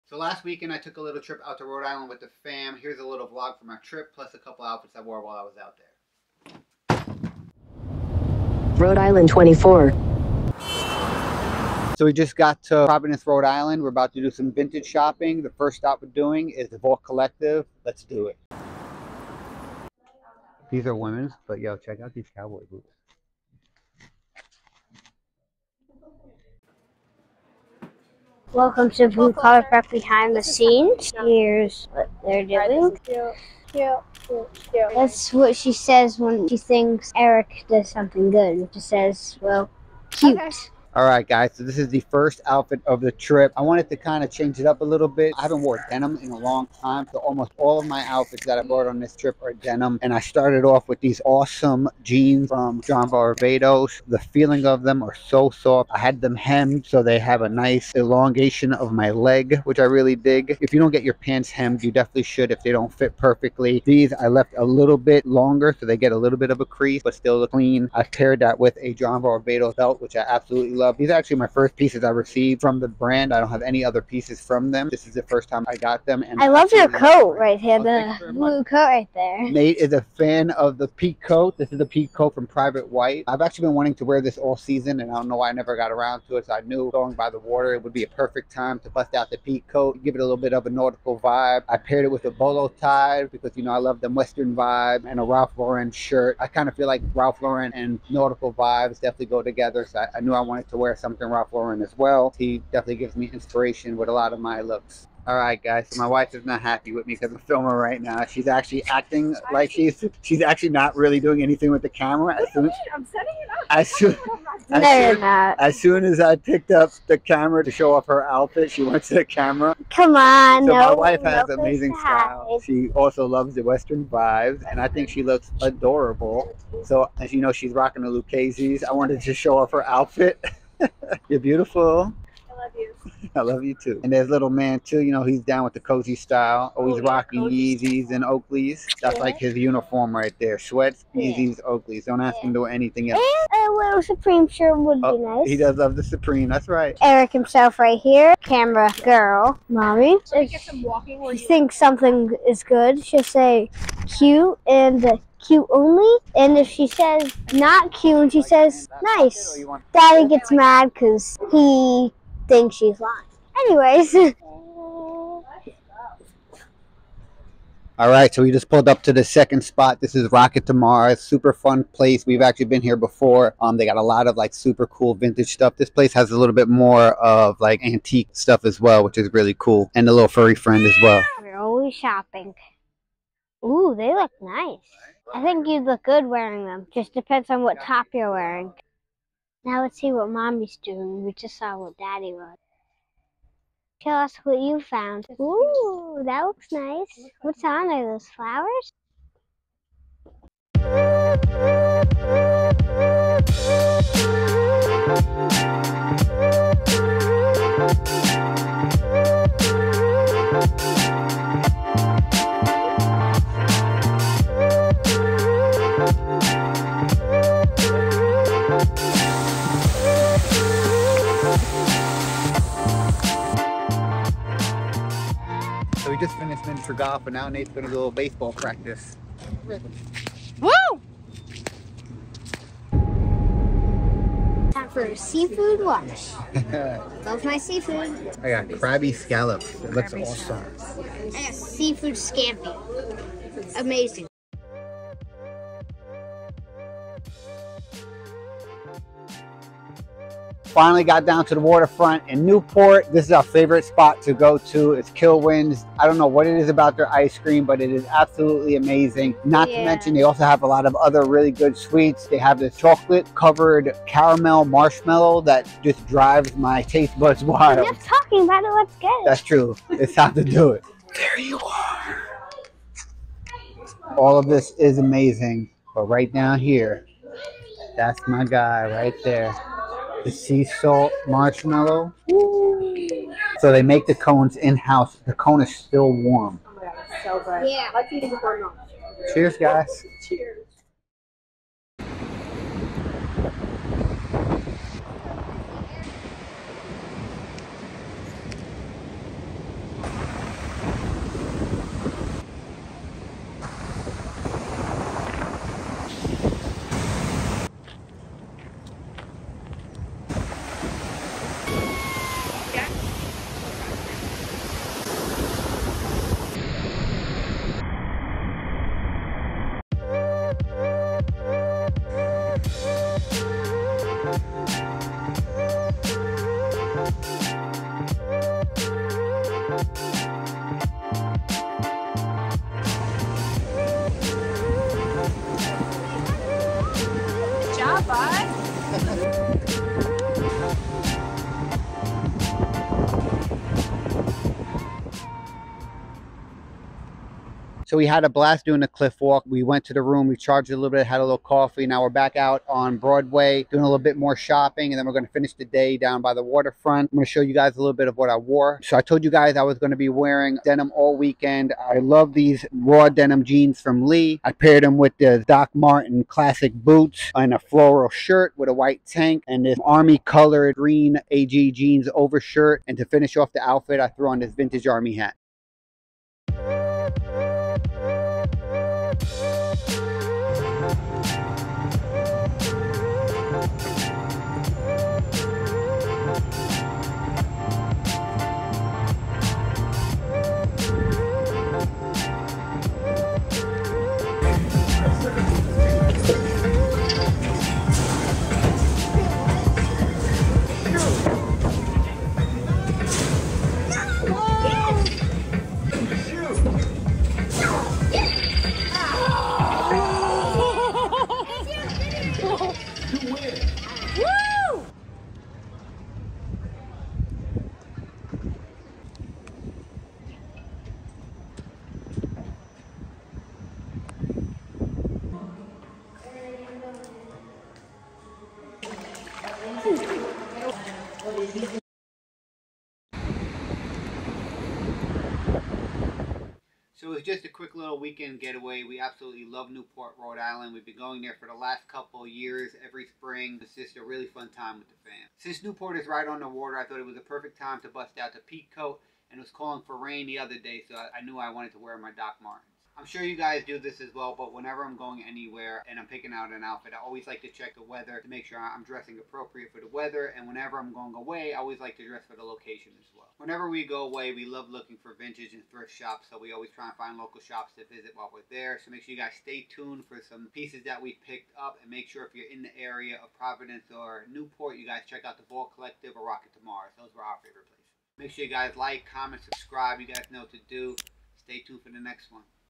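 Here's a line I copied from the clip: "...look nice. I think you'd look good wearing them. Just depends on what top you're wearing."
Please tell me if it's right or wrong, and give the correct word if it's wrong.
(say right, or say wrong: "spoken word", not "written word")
right.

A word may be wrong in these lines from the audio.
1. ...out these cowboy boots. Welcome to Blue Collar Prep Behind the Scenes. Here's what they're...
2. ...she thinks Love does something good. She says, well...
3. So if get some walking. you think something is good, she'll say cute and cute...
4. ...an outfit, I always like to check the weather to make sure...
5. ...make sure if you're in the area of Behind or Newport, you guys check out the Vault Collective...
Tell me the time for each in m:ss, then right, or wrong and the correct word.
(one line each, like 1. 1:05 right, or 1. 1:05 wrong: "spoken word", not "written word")
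1. 0:22 right
2. 0:36 wrong: "Eric", not "Love"
3. 2:30 right
4. 7:36 right
5. 7:51 wrong: "Providence", not "Behind".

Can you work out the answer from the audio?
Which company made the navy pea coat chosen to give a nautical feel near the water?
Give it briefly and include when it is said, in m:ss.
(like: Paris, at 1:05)
Private White, at 1:22.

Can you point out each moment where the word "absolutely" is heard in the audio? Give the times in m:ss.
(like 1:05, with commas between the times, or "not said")
1:10, 4:18, 7:19.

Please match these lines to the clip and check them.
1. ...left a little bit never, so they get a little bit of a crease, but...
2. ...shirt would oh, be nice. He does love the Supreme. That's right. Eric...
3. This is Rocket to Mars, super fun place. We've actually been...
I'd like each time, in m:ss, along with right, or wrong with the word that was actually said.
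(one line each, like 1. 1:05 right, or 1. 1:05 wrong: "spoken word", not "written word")
1. 1:04 wrong: "longer", not "never"
2. 2:24 right
3. 2:50 right.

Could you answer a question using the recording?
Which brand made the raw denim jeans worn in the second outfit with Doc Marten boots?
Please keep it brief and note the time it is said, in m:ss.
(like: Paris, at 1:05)
Lee, at 6:04.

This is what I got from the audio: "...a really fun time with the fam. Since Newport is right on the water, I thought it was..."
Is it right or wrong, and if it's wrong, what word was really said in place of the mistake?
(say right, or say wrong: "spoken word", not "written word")
right.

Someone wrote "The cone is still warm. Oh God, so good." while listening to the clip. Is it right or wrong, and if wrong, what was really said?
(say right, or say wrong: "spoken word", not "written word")
right.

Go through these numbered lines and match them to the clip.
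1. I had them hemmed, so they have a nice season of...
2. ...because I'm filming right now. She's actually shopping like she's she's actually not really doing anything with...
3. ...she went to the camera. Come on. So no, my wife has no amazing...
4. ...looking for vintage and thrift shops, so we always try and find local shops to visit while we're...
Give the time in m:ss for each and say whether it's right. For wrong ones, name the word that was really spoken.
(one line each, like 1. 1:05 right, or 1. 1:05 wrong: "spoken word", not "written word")
1. 0:55 wrong: "elongation", not "season"
2. 1:47 wrong: "acting", not "shopping"
3. 1:58 right
4. 7:44 right.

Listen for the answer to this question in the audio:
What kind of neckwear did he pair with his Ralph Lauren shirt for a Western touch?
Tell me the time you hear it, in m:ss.
1:32.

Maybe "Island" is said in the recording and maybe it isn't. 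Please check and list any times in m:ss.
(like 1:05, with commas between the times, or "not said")
0:01, 0:08, 0:13, 7:20.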